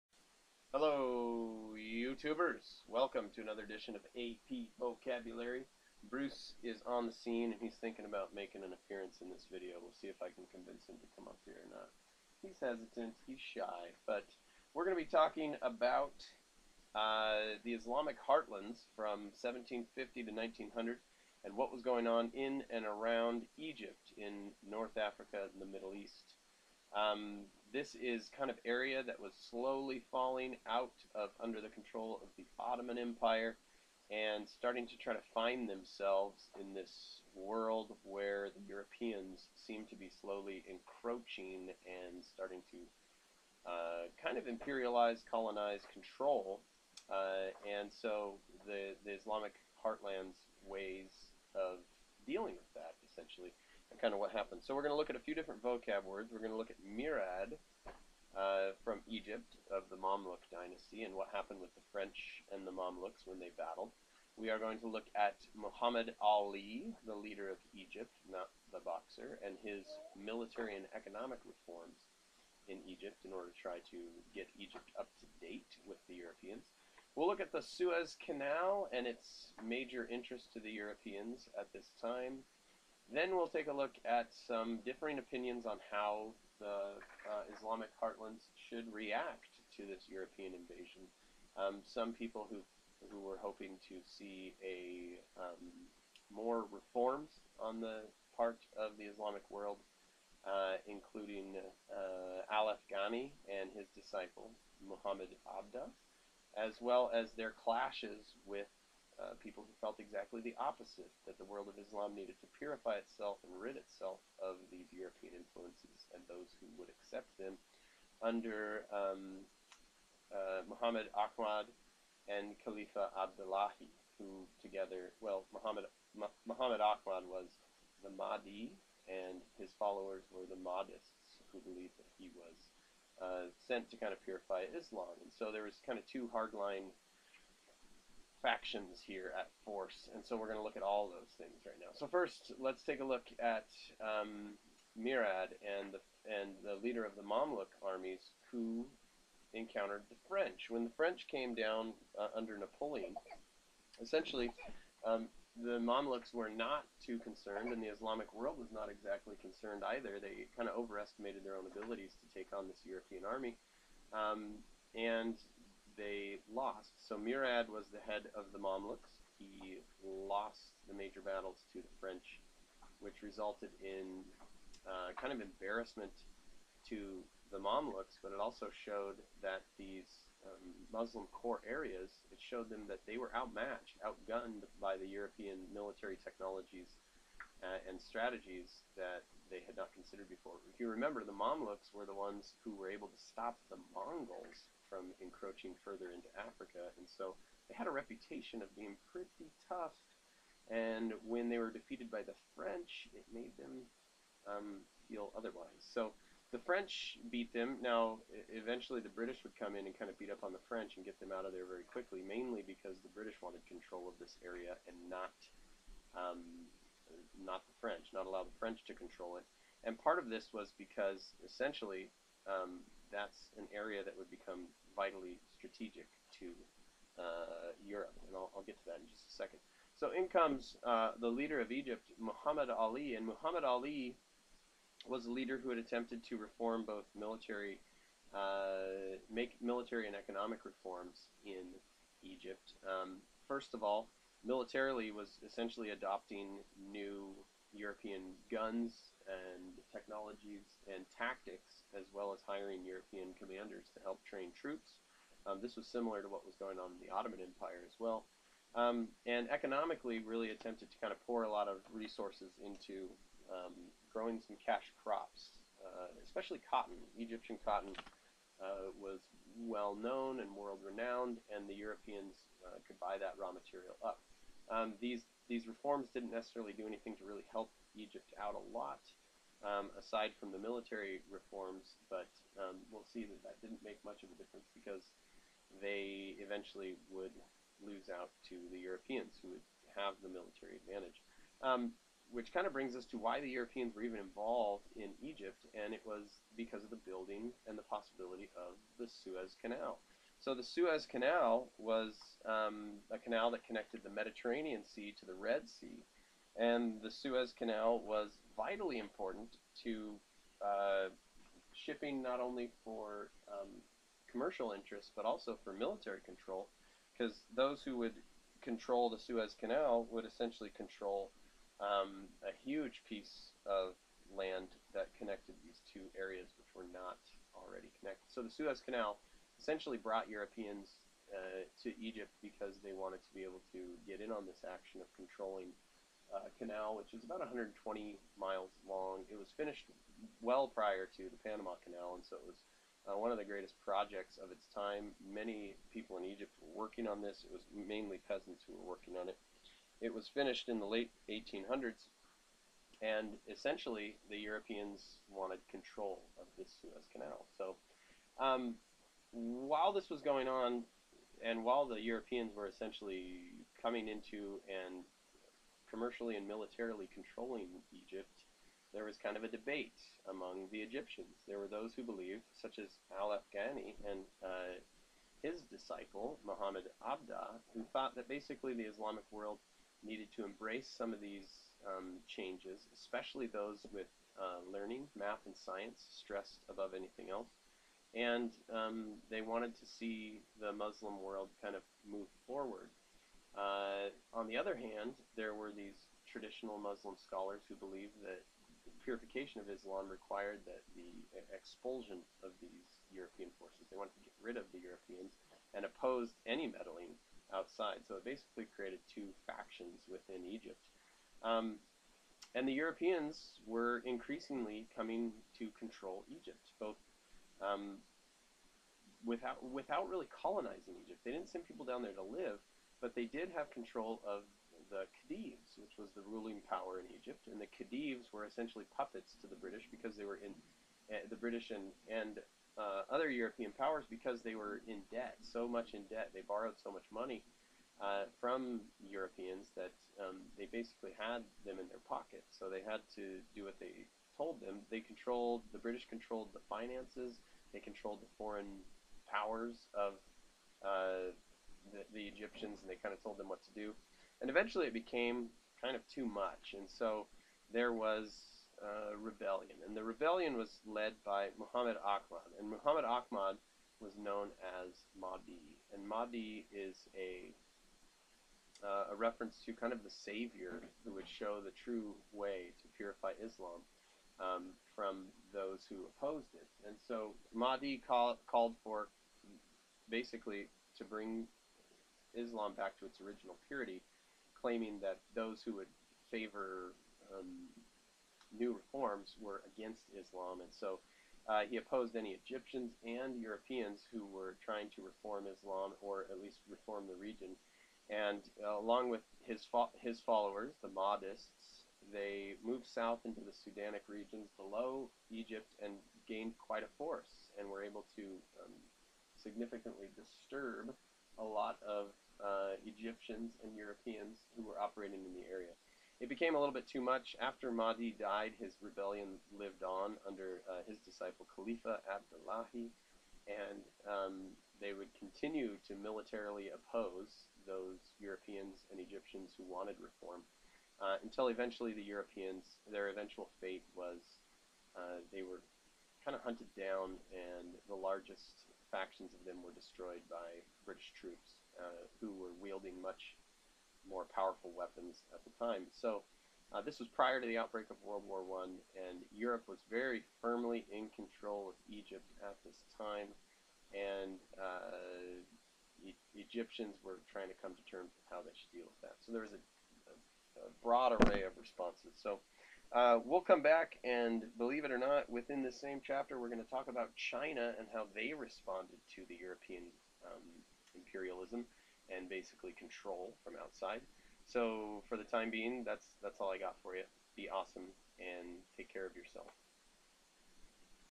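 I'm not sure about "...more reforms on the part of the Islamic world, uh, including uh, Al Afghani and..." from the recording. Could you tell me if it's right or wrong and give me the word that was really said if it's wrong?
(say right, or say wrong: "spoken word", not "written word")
right.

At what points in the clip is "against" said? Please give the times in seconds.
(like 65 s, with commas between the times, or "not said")
489 s.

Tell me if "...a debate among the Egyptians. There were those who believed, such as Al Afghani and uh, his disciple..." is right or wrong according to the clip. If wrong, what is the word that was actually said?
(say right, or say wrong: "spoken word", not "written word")
right.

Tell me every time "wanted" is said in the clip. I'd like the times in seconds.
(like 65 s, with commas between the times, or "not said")
213 s, 332 s, 355 s, 389 s, 403 s, 529 s.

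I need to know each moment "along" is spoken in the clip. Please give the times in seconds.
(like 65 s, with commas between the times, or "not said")
498 s.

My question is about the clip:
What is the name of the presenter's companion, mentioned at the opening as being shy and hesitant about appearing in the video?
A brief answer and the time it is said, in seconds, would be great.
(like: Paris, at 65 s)
Bruce, at 6 s.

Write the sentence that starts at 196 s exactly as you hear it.
And so they had a reputation of being pretty tough.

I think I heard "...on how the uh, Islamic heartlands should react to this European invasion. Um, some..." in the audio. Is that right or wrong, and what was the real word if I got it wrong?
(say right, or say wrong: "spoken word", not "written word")
right.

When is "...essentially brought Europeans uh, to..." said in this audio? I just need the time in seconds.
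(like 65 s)
329 s.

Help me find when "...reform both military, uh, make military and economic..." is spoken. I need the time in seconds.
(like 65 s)
236 s.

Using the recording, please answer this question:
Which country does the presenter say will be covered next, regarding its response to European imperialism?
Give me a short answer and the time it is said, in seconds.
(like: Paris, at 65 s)
China, at 567 s.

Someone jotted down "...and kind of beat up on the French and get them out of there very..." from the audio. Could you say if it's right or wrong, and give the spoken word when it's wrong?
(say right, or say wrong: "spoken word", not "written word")
right.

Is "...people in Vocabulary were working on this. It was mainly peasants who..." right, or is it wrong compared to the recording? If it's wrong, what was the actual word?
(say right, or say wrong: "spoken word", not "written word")
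wrong: "Egypt", not "Vocabulary".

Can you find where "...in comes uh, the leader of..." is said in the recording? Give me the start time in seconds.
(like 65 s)
230 s.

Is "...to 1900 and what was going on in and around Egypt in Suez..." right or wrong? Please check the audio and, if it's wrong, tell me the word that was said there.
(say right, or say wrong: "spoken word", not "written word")
wrong: "North", not "Suez".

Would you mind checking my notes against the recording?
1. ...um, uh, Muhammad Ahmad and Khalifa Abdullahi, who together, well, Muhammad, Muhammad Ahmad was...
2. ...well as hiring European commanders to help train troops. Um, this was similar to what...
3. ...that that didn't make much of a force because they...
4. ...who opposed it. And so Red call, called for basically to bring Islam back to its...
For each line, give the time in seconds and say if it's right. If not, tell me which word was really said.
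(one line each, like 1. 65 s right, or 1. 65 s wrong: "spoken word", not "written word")
1. 118 s right
2. 252 s right
3. 283 s wrong: "difference", not "force"
4. 475 s wrong: "Mahdi", not "Red".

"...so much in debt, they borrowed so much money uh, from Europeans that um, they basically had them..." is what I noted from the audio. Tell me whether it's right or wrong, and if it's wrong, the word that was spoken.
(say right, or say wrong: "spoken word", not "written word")
right.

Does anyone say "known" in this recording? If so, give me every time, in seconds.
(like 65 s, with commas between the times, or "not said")
269 s, 464 s.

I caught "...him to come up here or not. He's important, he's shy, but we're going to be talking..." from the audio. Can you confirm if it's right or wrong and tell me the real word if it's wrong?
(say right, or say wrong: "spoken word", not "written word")
wrong: "hesitant", not "important".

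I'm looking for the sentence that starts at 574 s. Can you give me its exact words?
So for the time being, that's that's all I got for you.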